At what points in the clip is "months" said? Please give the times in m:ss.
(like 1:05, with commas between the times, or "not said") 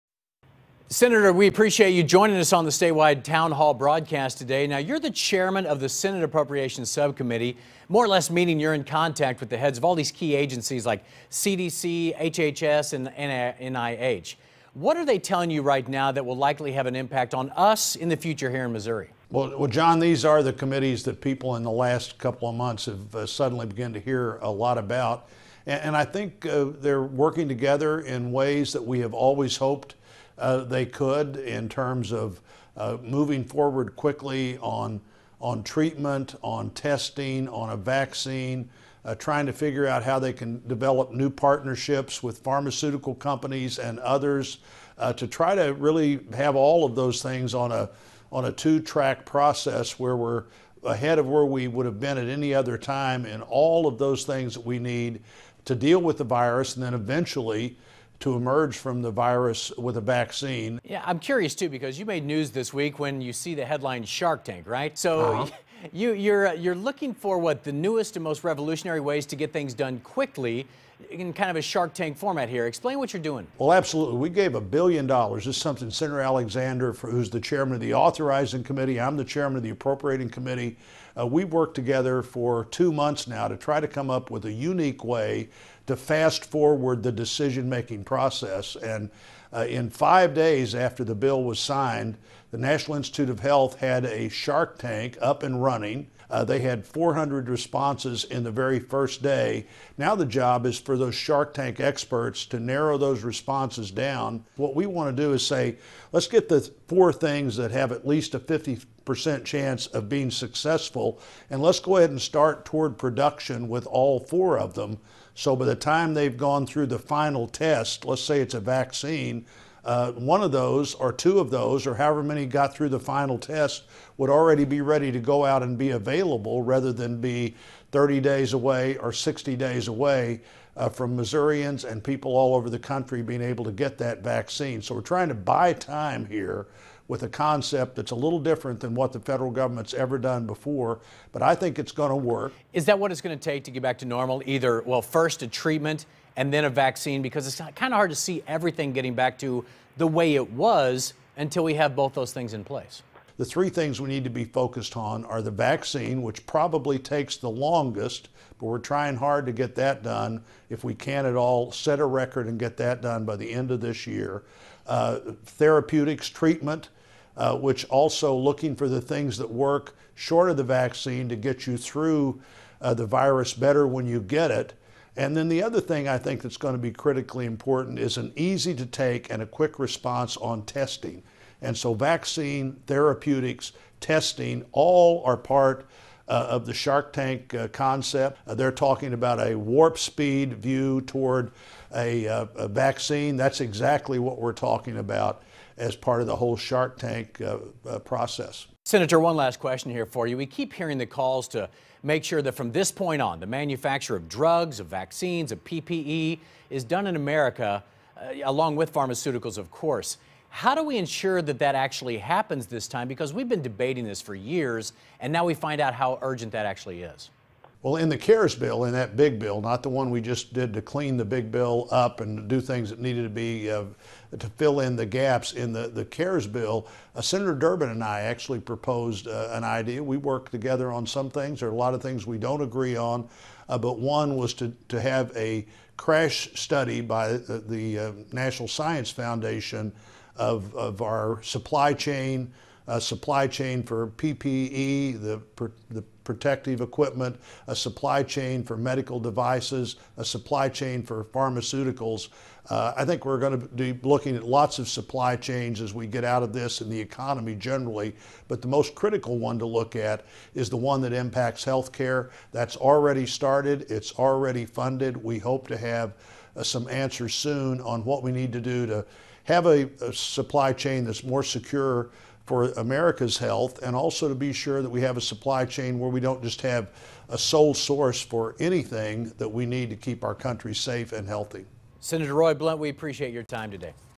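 0:22, 1:22.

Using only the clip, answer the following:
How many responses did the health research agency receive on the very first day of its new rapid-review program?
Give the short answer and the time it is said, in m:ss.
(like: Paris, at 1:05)
400, at 1:36.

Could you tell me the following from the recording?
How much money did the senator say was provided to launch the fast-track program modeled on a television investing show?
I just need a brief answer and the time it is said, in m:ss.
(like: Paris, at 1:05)
a billion dollars, at 1:14.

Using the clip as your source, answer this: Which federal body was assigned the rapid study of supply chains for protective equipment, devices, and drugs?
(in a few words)
National Science Foundation.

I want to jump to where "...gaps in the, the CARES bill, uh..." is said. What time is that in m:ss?
3:45.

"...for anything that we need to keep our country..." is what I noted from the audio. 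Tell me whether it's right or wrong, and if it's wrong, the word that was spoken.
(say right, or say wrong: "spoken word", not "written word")
right.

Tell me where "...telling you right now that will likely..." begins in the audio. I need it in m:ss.
0:15.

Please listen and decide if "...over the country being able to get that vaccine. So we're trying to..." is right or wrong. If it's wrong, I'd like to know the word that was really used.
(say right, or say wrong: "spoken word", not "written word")
right.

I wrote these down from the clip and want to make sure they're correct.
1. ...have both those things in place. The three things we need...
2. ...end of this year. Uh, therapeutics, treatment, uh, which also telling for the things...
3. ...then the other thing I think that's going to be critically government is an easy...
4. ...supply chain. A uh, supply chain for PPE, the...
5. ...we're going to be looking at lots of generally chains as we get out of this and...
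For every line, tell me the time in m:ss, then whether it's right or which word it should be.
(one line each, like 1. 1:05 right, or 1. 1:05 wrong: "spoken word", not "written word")
1. 2:31 right
2. 2:43 wrong: "looking", not "telling"
3. 2:55 wrong: "important", not "government"
4. 4:01 right
5. 4:13 wrong: "supply", not "generally".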